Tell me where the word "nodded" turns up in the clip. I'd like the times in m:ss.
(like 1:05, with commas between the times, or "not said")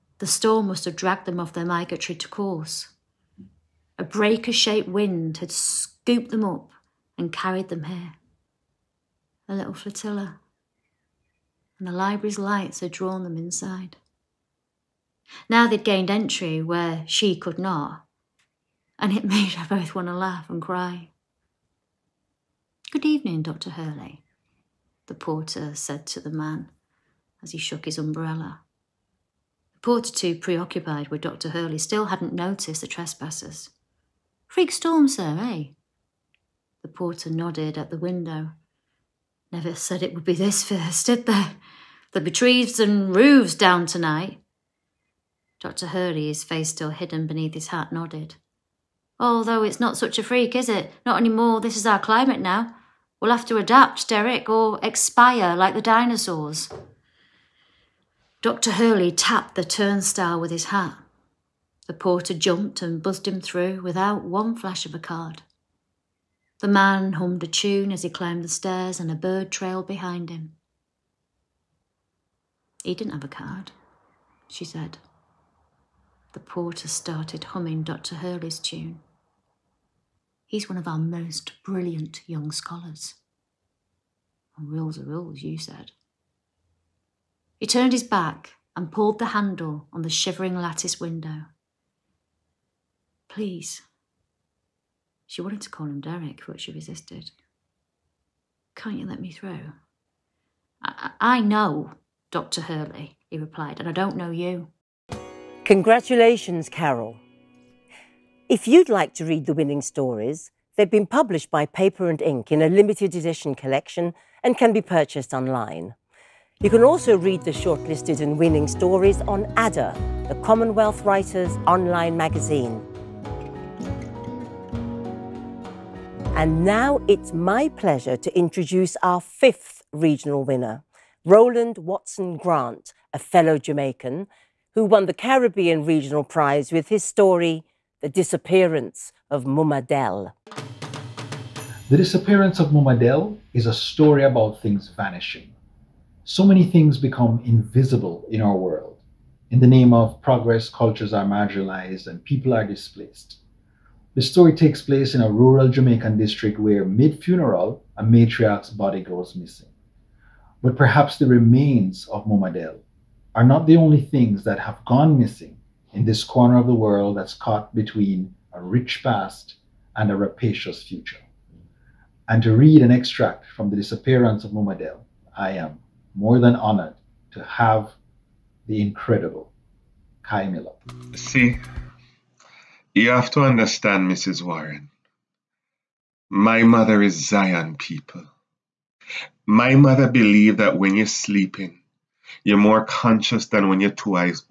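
0:37, 0:47.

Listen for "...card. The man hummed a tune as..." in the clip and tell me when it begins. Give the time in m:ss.
1:04.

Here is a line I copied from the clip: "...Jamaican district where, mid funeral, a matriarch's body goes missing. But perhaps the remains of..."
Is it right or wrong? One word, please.
right.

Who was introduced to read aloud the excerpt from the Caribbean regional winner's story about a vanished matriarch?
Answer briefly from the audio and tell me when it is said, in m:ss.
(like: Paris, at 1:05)
Kei Miller, at 3:00.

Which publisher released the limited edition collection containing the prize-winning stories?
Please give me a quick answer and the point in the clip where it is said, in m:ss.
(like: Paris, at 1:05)
Paper and Ink, at 1:51.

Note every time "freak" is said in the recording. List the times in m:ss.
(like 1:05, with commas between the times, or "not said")
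0:34, 0:50.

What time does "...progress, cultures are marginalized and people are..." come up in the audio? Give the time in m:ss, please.
2:30.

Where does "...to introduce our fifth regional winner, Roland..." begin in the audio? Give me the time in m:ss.
2:08.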